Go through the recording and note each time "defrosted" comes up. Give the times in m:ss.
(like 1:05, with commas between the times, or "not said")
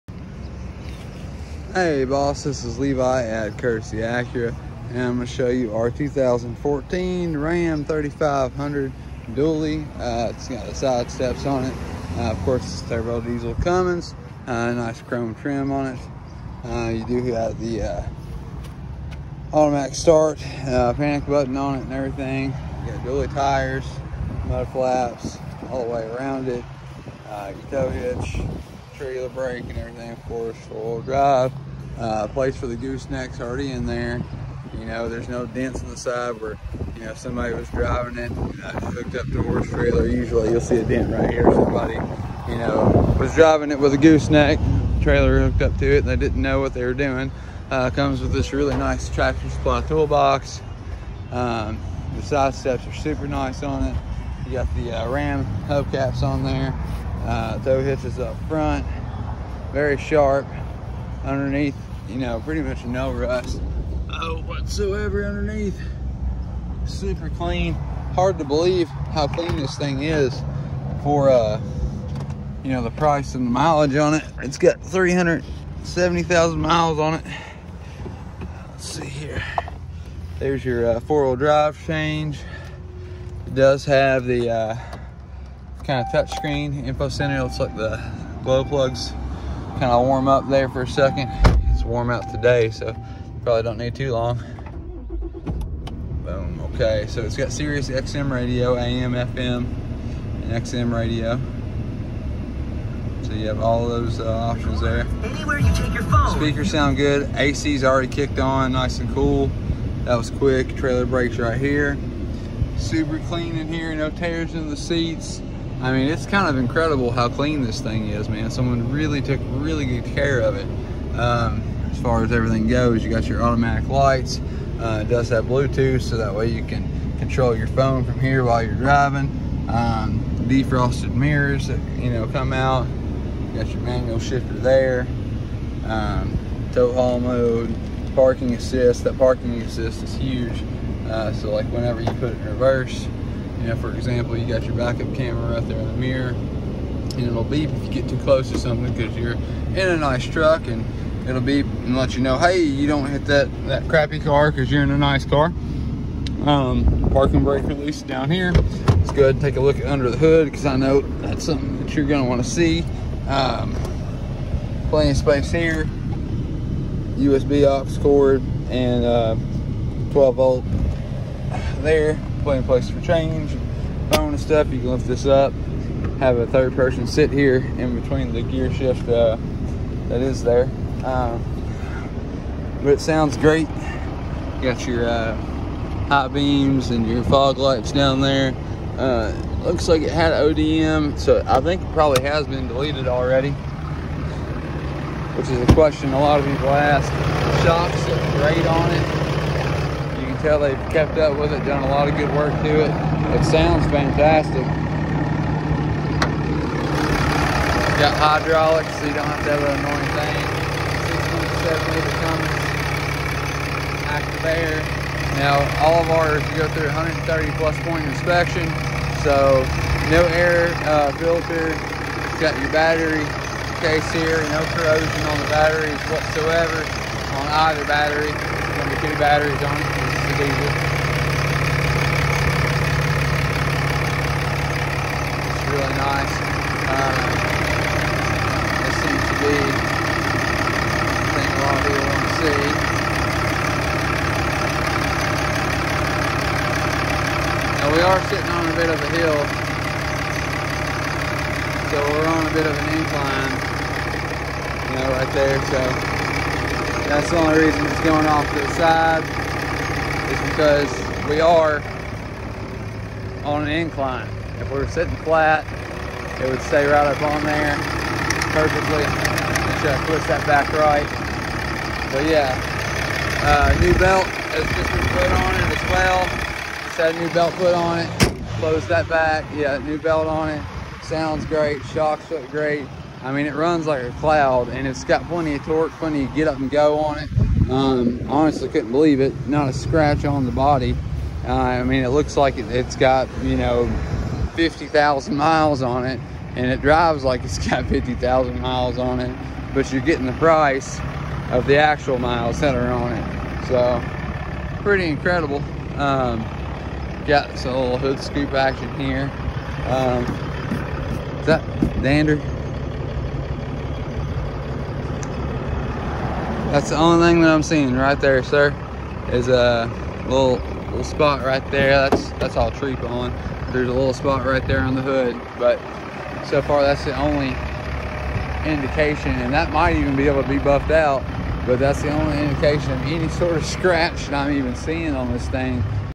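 2:10.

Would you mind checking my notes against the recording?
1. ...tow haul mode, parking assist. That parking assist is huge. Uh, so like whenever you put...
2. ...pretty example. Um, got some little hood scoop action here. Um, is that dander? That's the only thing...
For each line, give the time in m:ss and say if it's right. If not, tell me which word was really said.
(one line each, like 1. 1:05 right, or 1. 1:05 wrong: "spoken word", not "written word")
1. 2:16 right
2. 5:04 wrong: "incredible", not "example".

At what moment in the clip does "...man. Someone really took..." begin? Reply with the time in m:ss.
1:58.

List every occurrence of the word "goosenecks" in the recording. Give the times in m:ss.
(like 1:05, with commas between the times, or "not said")
0:32, 0:43.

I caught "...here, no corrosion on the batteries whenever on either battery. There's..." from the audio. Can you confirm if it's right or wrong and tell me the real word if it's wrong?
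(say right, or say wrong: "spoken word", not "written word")
wrong: "whatsoever", not "whenever".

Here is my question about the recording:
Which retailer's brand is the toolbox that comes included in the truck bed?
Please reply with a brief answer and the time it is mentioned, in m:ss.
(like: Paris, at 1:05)
Tractor Supply, at 0:49.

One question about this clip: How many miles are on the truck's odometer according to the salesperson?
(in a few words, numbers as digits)
370,000.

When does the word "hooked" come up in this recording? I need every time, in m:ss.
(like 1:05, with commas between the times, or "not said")
0:38, 0:45.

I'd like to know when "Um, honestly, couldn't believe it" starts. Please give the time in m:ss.
4:47.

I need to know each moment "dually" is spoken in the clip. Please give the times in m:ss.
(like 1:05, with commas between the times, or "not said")
0:09, 0:23.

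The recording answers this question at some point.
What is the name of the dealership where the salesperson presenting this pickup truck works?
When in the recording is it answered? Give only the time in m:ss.
0:03.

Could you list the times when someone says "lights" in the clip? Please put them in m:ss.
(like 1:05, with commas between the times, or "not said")
2:03, 3:07.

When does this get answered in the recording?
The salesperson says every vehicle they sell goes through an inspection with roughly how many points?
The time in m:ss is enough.
3:36.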